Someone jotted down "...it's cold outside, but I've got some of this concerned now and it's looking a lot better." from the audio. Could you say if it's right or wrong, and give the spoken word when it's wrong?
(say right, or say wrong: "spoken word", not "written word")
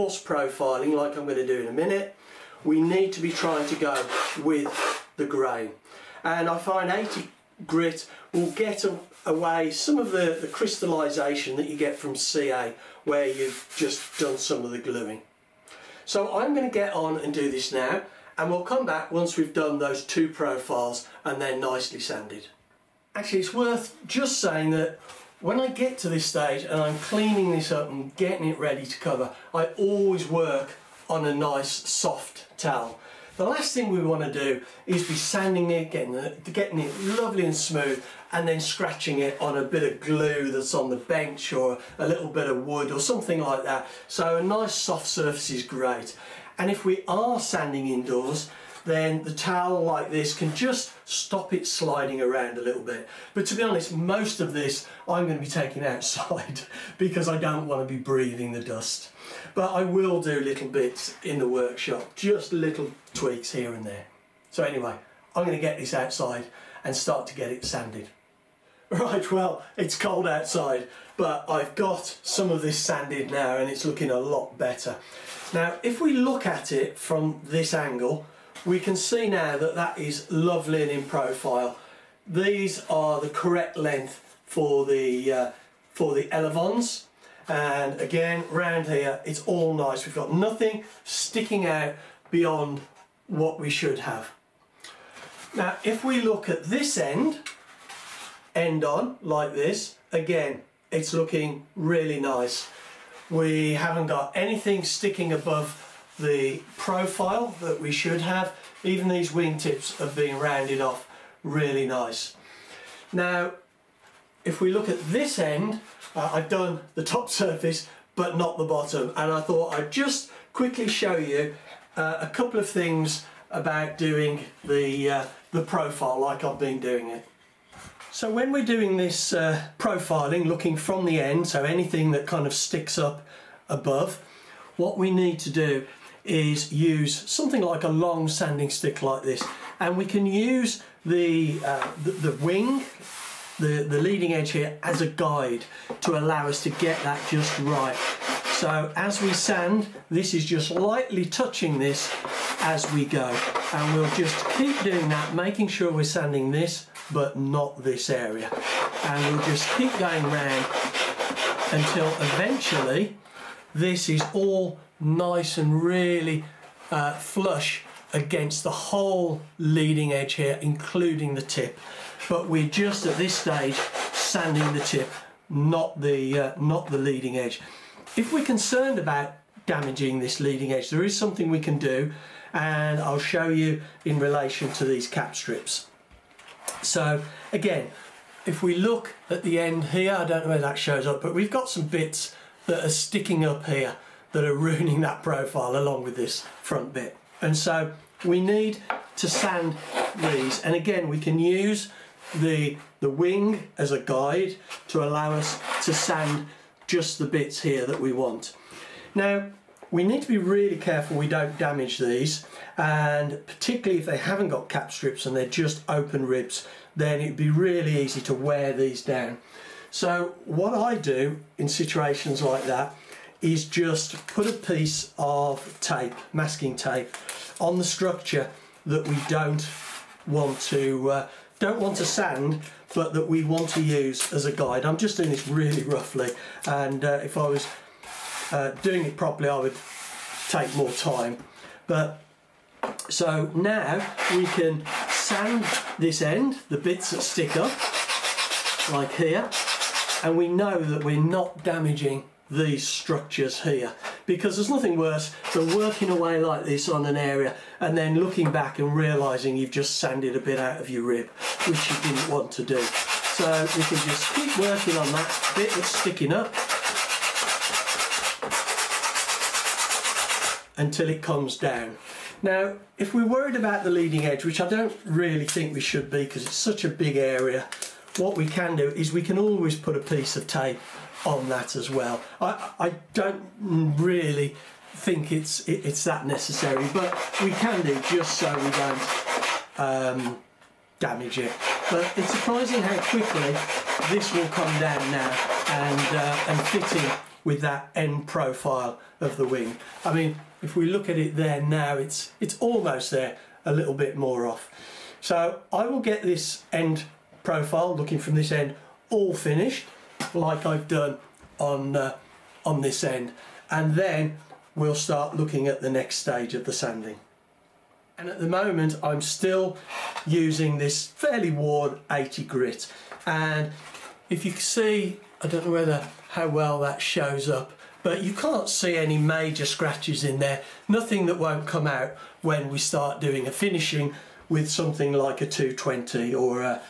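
wrong: "sanded", not "concerned".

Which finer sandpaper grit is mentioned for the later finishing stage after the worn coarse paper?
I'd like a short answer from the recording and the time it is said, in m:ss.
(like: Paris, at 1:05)
220, at 5:35.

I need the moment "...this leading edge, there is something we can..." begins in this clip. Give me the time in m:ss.
3:00.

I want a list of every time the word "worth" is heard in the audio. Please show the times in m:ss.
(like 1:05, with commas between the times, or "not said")
0:23.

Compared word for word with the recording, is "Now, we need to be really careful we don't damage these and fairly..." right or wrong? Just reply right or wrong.
wrong.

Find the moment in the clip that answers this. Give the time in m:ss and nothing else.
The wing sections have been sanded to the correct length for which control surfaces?
1:26.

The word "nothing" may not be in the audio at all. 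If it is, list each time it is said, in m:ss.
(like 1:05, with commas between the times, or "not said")
1:30, 4:14, 5:30.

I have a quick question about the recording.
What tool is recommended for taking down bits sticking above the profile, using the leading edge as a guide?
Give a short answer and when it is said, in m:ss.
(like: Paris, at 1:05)
Long sanding stick, at 2:17.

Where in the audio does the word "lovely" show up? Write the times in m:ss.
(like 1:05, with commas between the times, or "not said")
0:37, 1:20.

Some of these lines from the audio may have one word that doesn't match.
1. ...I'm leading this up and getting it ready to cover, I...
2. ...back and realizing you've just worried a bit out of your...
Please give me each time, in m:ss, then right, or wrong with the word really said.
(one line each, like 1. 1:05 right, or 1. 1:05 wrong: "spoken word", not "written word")
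1. 0:26 wrong: "cleaning", not "leading"
2. 4:18 wrong: "sanded", not "worried".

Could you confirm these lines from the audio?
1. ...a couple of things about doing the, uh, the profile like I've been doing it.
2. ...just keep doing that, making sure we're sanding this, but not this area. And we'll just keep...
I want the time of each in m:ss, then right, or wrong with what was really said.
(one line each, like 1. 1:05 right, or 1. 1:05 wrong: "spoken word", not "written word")
1. 2:02 right
2. 2:34 right.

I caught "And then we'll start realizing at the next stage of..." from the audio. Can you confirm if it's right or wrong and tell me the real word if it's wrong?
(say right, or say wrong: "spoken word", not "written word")
wrong: "looking", not "realizing".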